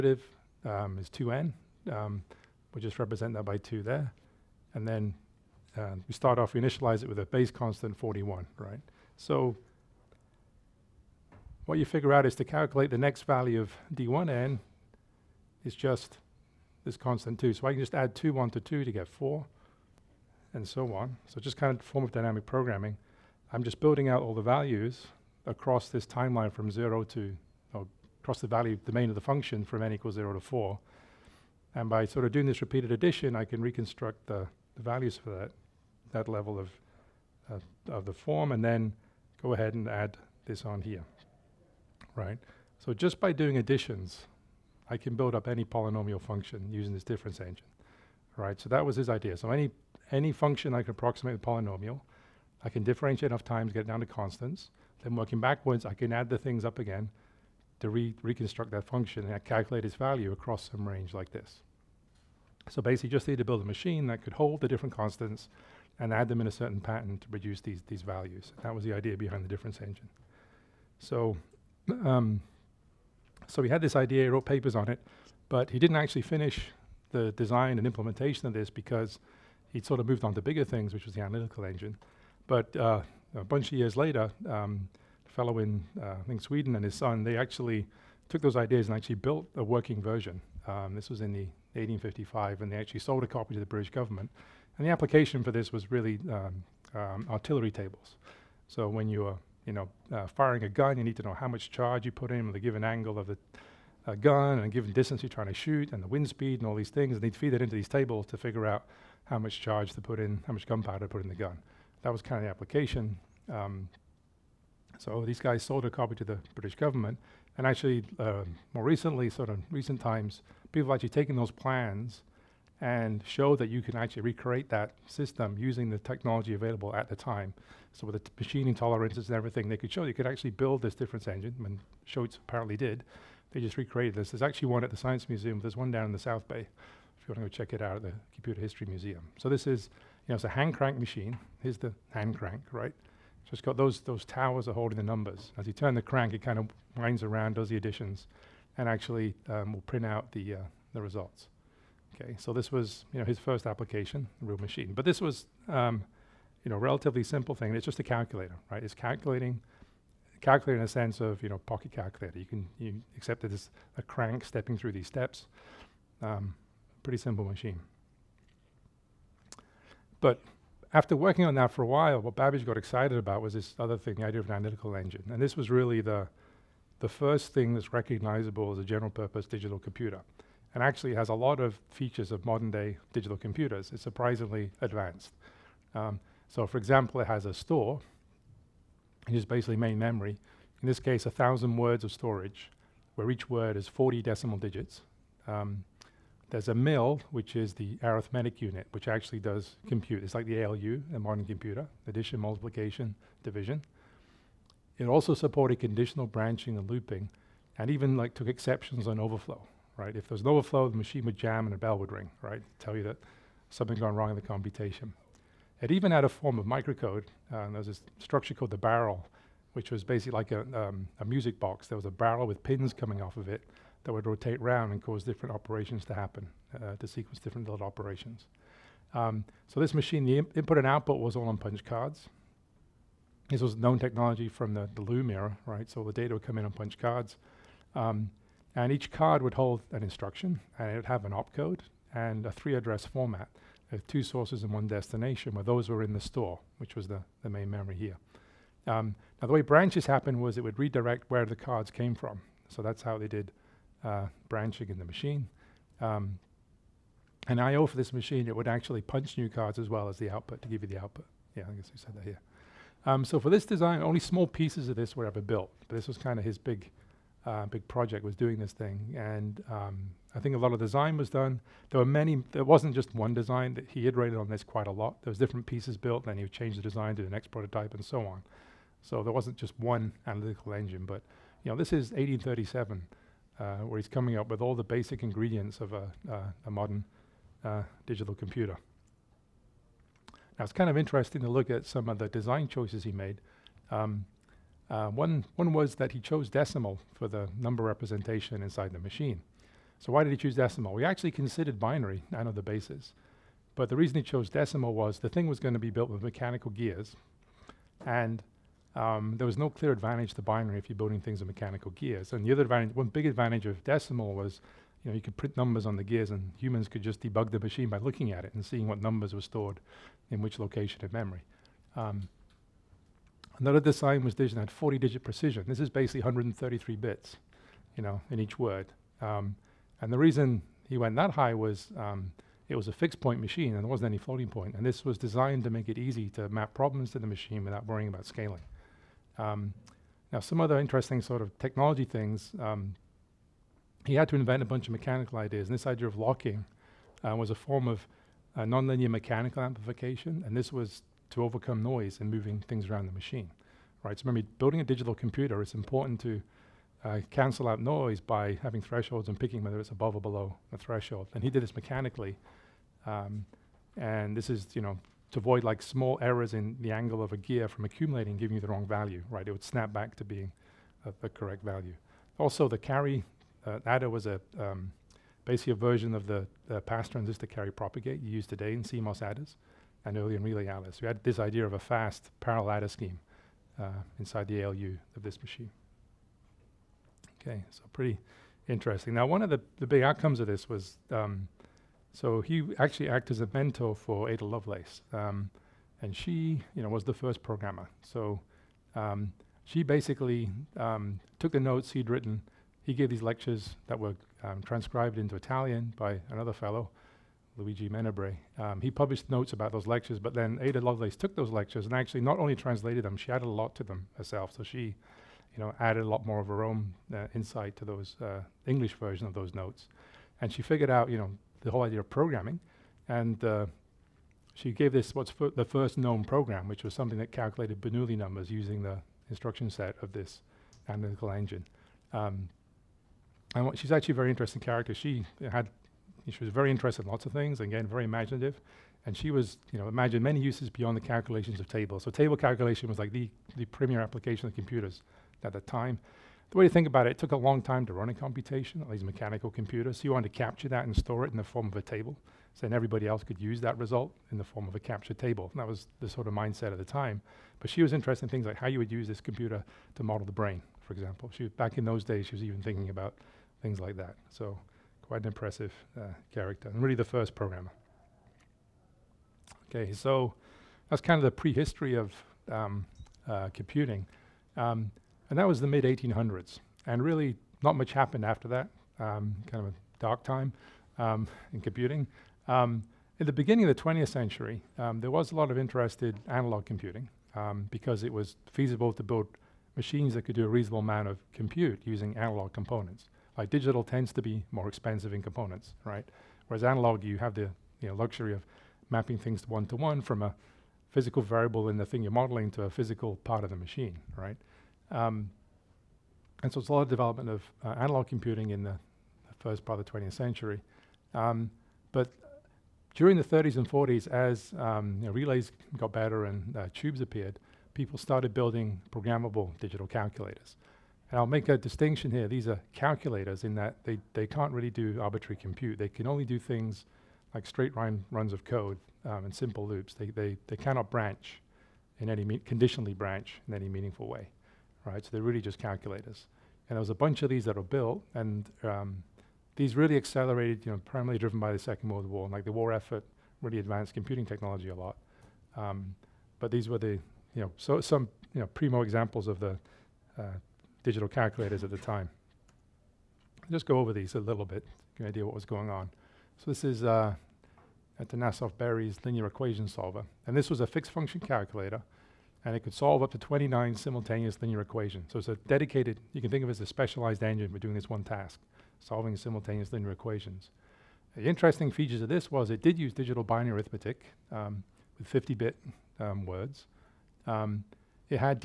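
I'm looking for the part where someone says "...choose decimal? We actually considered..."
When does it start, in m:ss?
5:00.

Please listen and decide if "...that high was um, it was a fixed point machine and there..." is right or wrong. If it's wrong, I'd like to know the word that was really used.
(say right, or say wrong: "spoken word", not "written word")
right.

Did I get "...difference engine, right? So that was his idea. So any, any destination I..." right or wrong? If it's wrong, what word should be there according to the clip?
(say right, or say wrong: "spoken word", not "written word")
wrong: "function", not "destination".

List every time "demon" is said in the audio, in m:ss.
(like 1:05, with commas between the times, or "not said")
not said.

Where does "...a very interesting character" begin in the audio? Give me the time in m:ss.
7:14.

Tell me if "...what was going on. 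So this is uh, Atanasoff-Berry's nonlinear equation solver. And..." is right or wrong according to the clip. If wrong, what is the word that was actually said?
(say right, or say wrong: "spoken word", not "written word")
wrong: "linear", not "nonlinear".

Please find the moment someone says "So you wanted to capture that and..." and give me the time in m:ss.
7:29.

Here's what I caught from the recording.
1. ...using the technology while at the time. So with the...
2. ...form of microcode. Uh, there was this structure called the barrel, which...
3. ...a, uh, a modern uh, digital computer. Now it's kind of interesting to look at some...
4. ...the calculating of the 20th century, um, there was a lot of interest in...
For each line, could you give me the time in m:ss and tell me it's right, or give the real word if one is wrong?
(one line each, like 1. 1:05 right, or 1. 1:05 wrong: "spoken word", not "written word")
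1. 2:05 wrong: "available", not "while"
2. 3:36 right
3. 4:45 right
4. 8:03 wrong: "beginning", not "calculating".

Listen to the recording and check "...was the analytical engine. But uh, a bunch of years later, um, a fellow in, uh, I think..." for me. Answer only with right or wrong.
right.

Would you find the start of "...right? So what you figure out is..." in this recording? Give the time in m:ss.
0:08.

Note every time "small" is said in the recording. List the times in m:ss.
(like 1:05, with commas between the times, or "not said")
4:24, 6:05.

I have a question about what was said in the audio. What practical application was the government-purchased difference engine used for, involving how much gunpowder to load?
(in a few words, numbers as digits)
Artillery tables.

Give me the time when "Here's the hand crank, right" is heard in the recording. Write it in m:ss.
2:21.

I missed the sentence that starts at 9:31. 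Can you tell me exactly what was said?
The interesting features of this was it did use digital binary arithmetic um, with 50-bit um, words.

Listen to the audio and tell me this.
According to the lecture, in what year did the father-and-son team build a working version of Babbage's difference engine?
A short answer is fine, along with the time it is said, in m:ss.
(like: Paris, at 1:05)
1855, at 1:31.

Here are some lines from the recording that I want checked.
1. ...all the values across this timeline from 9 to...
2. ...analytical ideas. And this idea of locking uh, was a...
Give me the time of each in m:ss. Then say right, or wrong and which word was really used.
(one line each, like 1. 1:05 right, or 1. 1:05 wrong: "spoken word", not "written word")
1. 0:24 wrong: "0", not "9"
2. 5:44 wrong: "mechanical", not "analytical".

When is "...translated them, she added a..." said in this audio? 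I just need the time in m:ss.
6:52.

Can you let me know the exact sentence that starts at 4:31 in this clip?
There were many, there wasn't just one design, that he iterated on this quite a lot.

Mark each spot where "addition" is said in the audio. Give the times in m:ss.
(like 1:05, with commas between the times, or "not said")
0:32, 0:43, 2:27, 3:22.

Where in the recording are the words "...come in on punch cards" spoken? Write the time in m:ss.
3:56.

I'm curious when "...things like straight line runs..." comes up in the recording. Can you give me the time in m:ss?
8:46.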